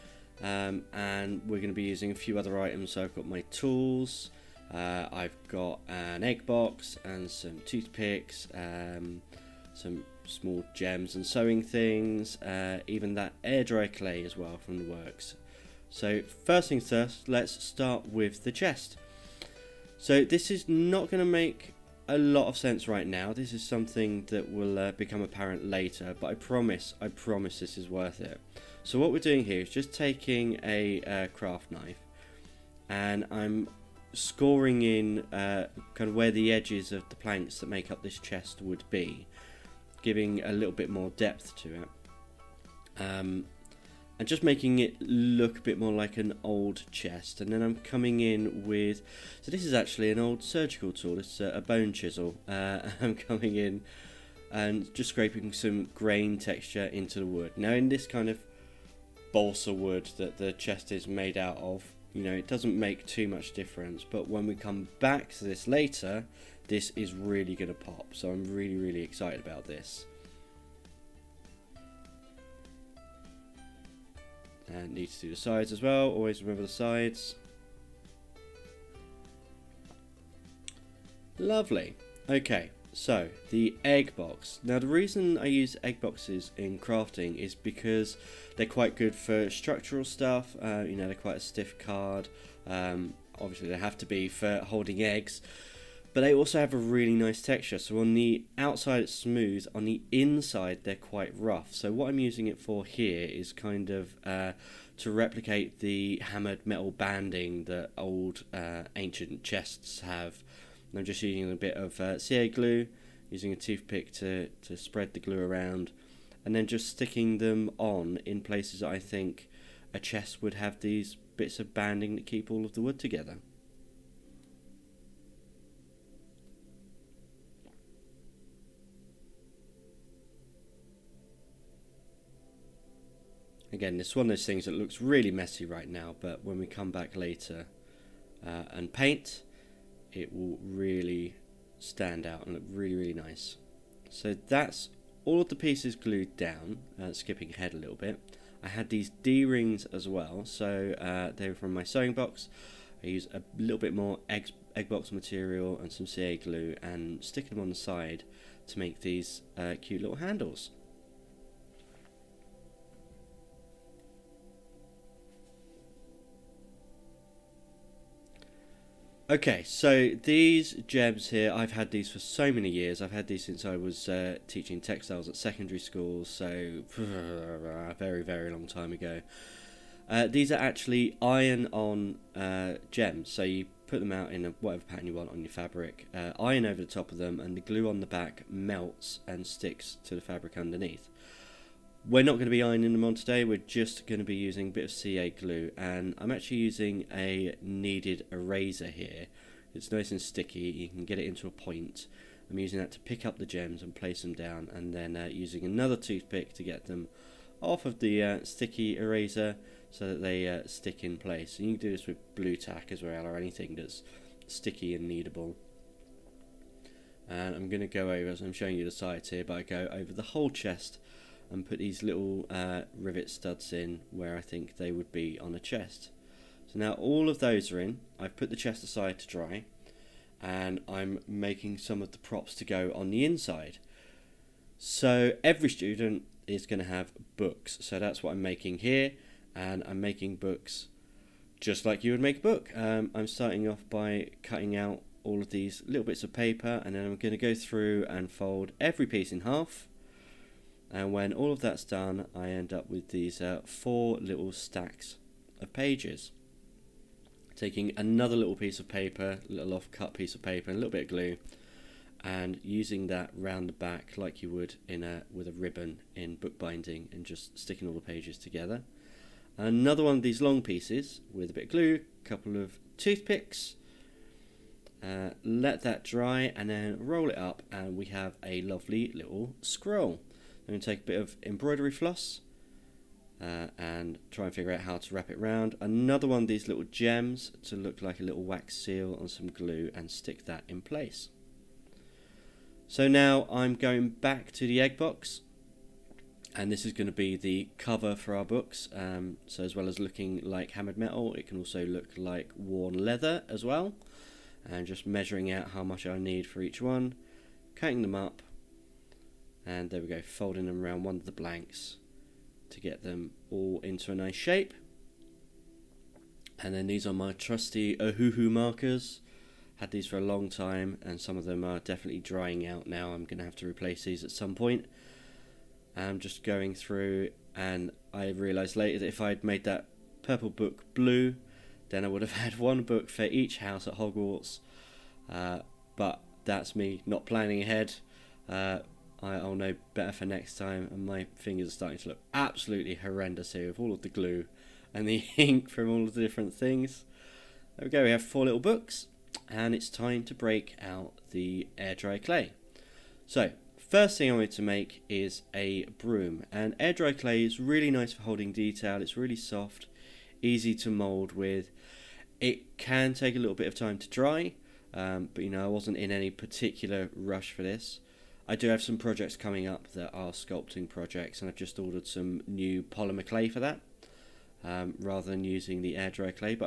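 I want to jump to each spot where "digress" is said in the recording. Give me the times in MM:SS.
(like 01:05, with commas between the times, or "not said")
not said.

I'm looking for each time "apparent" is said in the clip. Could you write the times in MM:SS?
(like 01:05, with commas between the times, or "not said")
00:25.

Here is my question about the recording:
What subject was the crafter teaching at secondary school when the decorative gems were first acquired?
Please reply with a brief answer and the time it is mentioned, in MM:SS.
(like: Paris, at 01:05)
textiles, at 02:54.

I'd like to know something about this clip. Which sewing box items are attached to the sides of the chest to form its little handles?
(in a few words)
D-rings.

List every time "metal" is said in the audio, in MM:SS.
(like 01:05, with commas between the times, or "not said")
01:46, 05:00.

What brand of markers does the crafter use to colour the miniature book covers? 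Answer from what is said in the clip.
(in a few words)
Ohuhu.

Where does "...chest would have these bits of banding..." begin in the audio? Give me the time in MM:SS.
02:00.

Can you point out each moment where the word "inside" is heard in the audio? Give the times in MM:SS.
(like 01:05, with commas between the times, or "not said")
01:40, 03:53.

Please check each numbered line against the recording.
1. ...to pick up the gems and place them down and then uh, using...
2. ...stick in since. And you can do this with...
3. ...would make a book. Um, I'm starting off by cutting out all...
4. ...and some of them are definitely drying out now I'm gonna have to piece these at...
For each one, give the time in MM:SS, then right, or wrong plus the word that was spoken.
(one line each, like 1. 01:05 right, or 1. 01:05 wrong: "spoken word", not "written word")
1. 03:22 right
2. 03:30 wrong: "place", not "since"
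3. 04:02 right
4. 05:21 wrong: "replace", not "piece".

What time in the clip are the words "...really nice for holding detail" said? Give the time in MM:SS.
05:57.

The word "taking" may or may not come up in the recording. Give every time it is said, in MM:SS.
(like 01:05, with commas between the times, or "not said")
00:29, 04:17.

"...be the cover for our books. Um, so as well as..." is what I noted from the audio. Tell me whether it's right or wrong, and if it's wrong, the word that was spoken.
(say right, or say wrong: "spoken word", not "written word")
right.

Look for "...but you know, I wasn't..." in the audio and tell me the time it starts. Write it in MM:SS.
06:05.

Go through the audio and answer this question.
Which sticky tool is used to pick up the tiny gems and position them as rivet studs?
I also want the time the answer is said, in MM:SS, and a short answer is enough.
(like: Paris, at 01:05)
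kneaded eraser, at 03:17.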